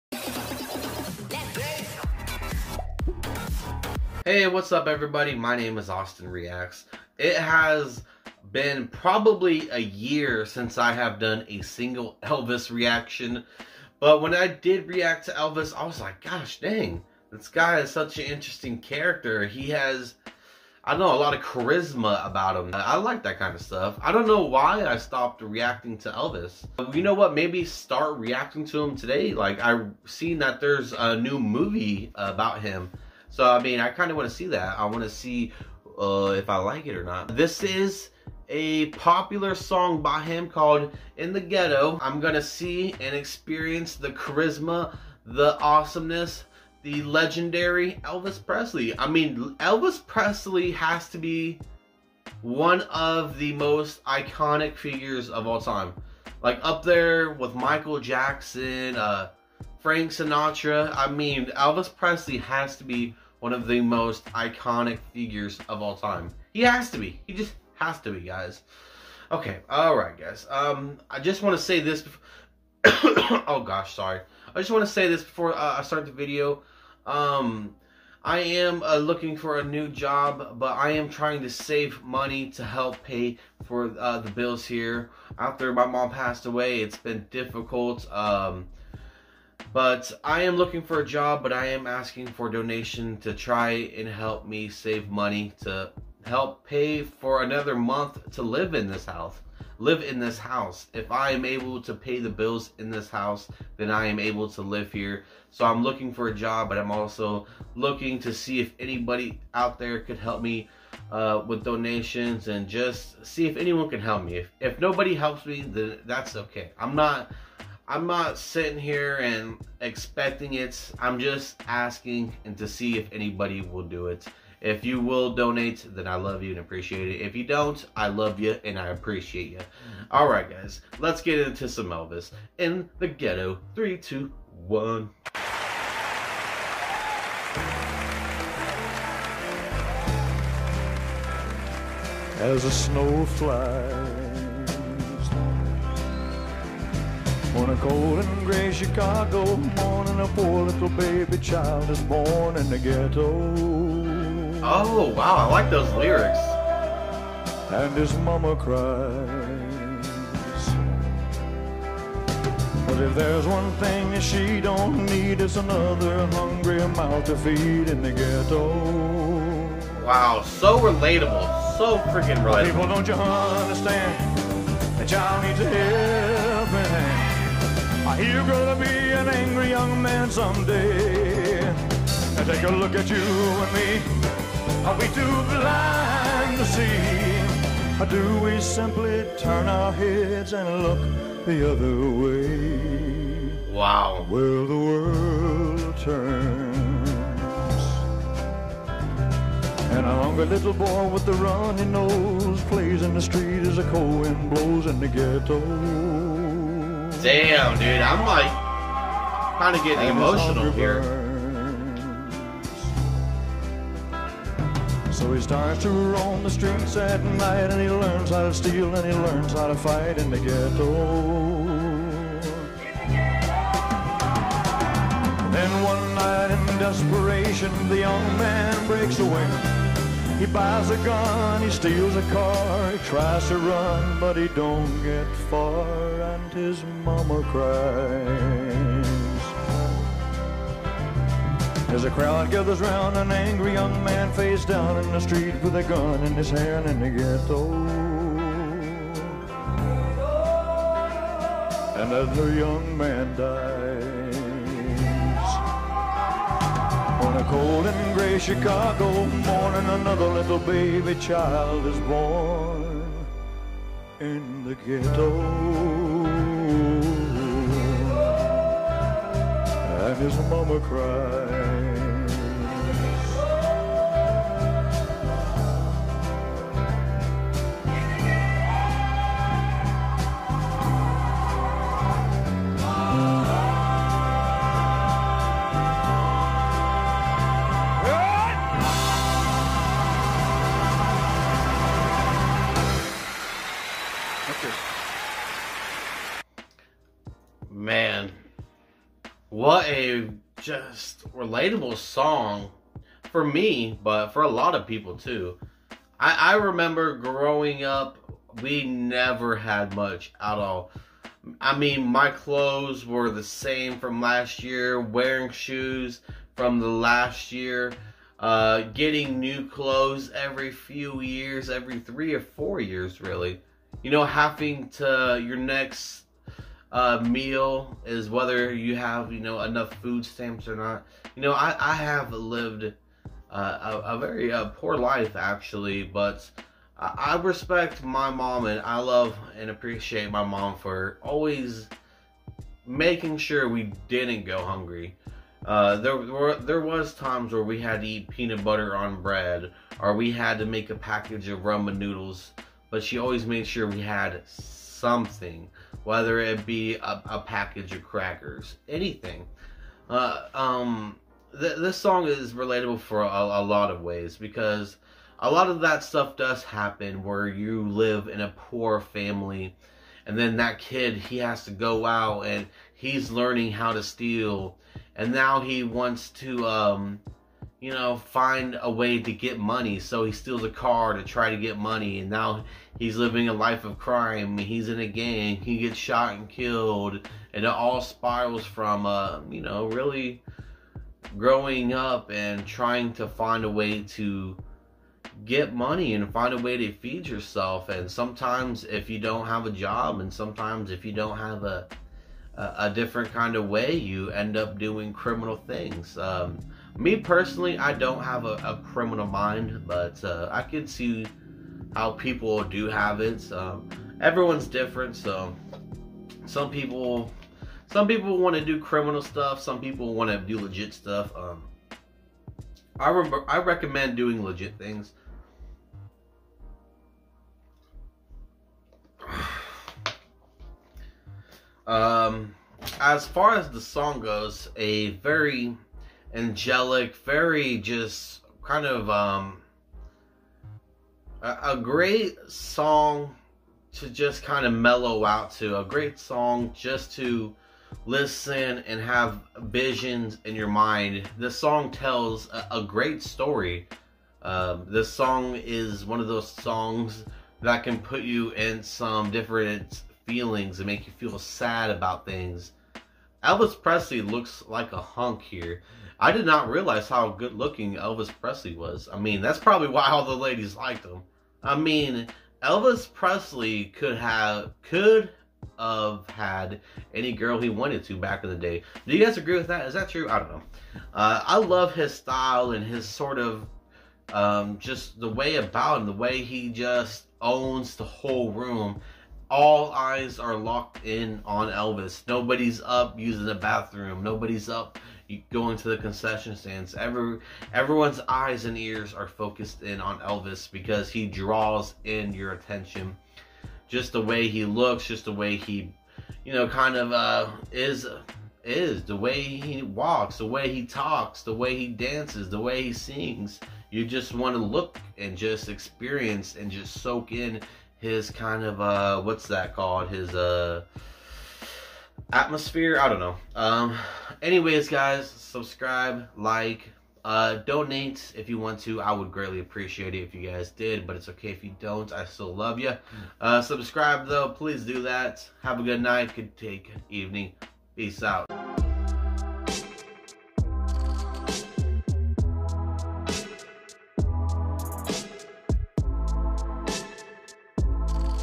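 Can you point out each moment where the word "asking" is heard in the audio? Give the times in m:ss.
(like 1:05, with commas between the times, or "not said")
1:31, 2:01.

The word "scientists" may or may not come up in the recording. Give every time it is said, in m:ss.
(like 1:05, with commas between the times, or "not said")
not said.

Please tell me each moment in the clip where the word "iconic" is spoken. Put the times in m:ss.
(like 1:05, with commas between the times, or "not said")
0:54, 1:04.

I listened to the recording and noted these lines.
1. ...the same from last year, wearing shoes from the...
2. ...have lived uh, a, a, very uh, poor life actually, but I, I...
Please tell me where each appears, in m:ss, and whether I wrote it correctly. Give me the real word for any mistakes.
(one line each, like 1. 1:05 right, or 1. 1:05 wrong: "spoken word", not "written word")
1. 5:13 right
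2. 5:31 right.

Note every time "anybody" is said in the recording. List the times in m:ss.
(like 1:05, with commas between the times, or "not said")
1:48, 2:03.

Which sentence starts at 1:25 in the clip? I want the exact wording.
After my mom passed away, it's been difficult.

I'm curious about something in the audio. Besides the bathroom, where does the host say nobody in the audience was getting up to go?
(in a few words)
Concession stands.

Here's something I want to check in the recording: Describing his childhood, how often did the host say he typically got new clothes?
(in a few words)
Every 3 or 4 years.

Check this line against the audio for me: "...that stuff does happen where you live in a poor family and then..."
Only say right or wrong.
right.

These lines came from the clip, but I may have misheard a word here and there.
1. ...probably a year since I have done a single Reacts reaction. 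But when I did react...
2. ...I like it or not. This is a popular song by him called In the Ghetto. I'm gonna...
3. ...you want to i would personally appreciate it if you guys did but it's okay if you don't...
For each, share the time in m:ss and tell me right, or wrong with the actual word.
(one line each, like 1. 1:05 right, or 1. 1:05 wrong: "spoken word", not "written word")
1. 0:08 wrong: "Elvis", not "Reacts"
2. 0:36 right
3. 8:48 wrong: "greatly", not "personally".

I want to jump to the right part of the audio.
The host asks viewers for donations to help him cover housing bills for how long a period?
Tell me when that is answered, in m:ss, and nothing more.
1:37.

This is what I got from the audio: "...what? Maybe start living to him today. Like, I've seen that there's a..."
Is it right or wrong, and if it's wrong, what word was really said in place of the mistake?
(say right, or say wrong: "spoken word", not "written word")
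wrong: "reacting", not "living".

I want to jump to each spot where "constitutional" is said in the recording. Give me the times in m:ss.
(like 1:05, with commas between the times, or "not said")
not said.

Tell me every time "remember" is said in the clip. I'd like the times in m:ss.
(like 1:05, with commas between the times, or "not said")
5:06, 7:03.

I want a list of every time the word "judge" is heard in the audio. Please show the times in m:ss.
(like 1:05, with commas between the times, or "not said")
not said.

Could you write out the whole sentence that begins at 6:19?
So he steals a car to try to get money, and now he's living a life of crime.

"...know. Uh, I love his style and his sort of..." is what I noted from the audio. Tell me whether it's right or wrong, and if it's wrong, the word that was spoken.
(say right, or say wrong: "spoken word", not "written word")
right.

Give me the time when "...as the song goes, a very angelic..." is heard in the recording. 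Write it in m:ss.
7:13.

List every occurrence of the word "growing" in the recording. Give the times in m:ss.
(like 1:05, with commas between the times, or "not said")
5:07, 6:31.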